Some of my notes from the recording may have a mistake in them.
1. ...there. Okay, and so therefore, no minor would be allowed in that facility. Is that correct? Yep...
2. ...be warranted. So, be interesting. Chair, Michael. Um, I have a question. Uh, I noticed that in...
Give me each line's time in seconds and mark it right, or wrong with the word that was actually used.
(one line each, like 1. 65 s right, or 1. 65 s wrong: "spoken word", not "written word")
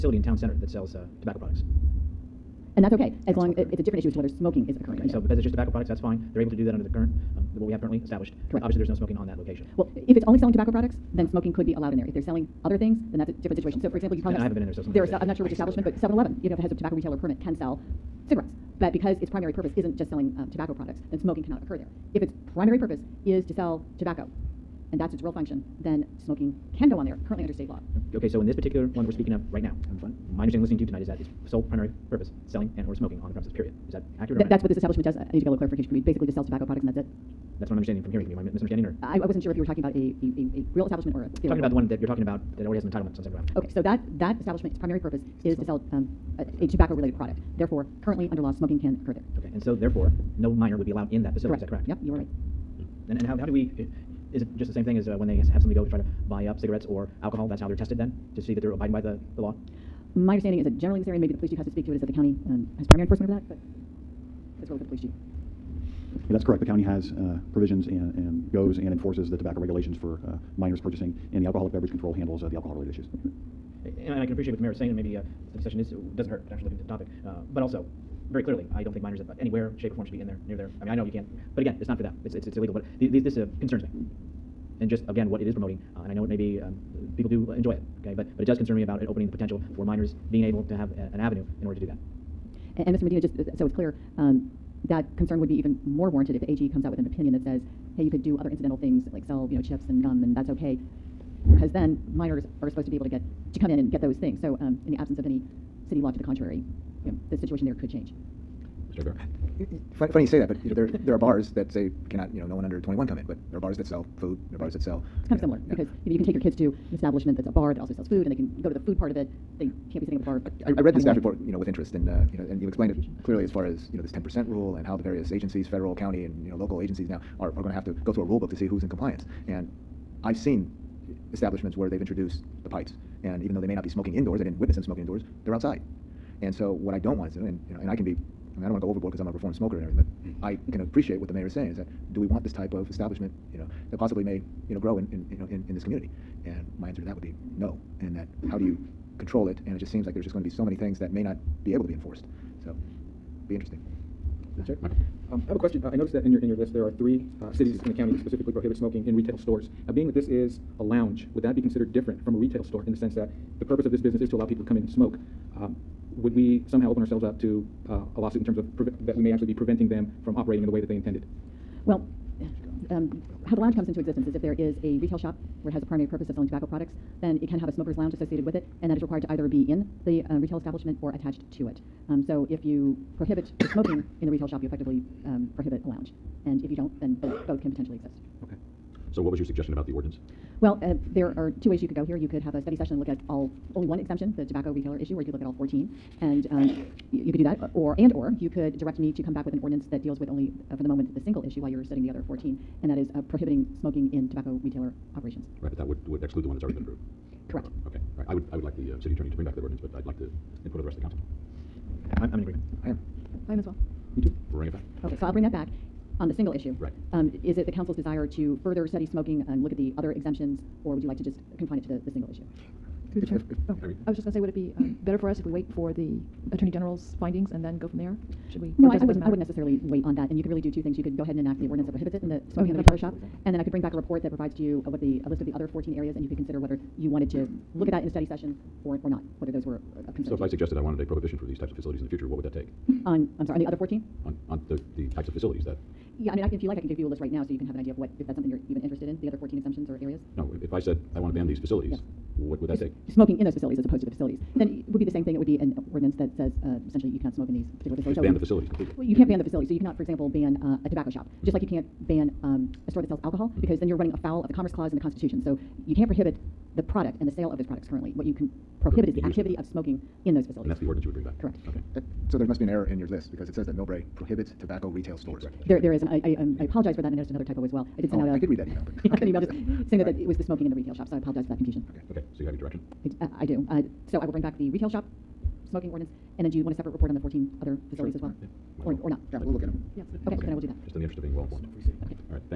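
1. 49 s right
2. 151 s wrong: "enforced", not "warranted".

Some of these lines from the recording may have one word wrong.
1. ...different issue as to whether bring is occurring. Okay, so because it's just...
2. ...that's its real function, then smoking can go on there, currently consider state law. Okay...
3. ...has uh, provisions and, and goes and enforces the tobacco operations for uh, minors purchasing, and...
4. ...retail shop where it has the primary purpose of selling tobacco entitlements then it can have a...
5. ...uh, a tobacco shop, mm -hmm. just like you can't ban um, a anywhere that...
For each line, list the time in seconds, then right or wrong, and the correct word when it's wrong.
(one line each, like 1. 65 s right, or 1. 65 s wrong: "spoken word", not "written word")
1. 3 s wrong: "smoking", not "bring"
2. 24 s wrong: "under", not "consider"
3. 66 s wrong: "regulations", not "operations"
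4. 175 s wrong: "products", not "entitlements"
5. 260 s wrong: "store", not "anywhere".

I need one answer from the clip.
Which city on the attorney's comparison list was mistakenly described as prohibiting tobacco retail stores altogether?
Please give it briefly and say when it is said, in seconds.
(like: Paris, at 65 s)
Millbrae, at 273 s.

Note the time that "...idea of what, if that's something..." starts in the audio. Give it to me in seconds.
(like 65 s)
247 s.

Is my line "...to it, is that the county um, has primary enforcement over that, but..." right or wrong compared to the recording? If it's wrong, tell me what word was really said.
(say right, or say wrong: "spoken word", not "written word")
right.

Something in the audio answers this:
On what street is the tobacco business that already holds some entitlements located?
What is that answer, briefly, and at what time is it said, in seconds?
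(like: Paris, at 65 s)
San Bernardino Avenue, at 43 s.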